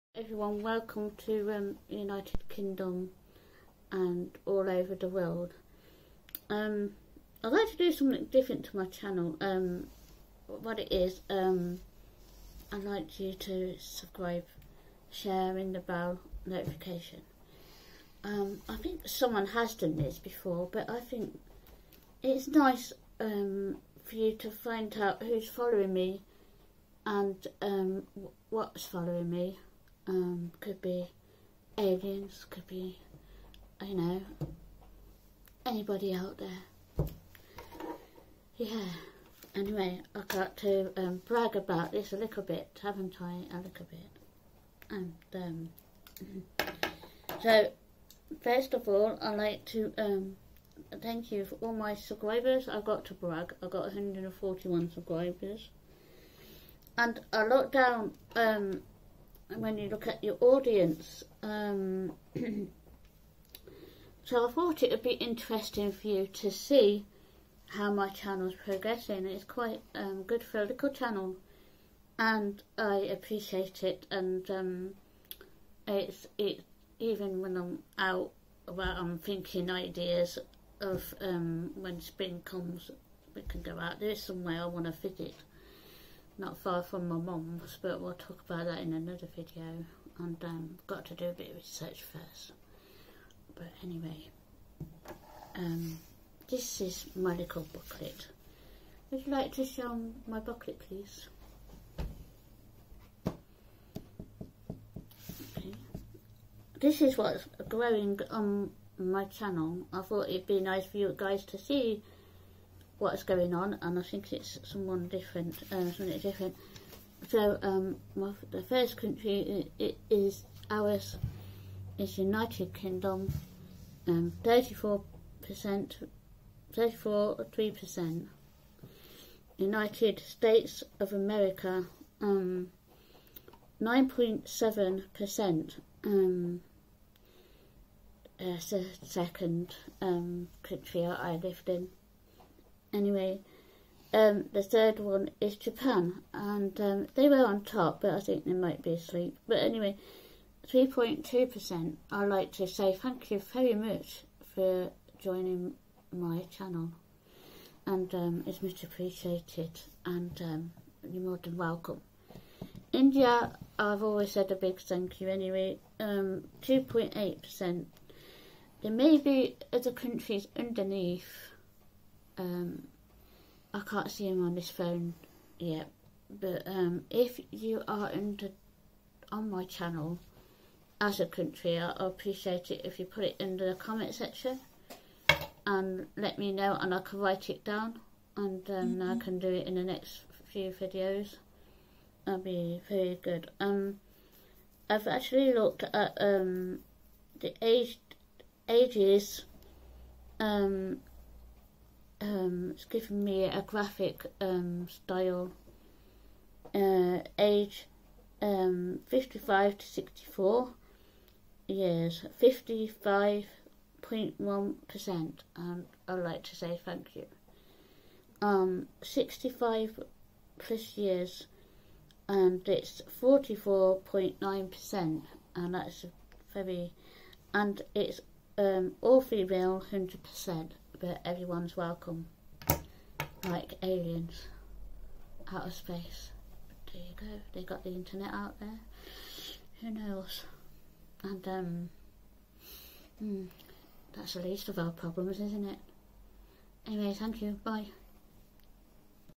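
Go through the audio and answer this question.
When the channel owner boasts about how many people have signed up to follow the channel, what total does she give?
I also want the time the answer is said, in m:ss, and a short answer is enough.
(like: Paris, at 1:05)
141, at 0:53.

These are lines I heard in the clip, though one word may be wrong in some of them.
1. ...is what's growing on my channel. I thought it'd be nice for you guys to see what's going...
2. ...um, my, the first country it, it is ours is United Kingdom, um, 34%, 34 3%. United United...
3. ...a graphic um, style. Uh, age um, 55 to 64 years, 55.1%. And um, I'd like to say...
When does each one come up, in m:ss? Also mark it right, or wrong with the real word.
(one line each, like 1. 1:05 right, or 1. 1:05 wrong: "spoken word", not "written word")
1. 1:47 right
2. 1:57 wrong: "States", not "United"
3. 3:23 right.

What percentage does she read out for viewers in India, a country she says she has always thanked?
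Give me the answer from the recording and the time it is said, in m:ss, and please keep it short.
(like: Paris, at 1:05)
2.8%, at 2:46.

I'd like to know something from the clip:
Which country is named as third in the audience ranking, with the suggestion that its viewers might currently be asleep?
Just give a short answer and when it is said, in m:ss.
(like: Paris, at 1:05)
Japan, at 2:25.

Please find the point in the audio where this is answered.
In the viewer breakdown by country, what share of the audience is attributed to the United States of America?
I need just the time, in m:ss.
2:13.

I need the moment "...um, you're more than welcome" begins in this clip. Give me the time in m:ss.
2:40.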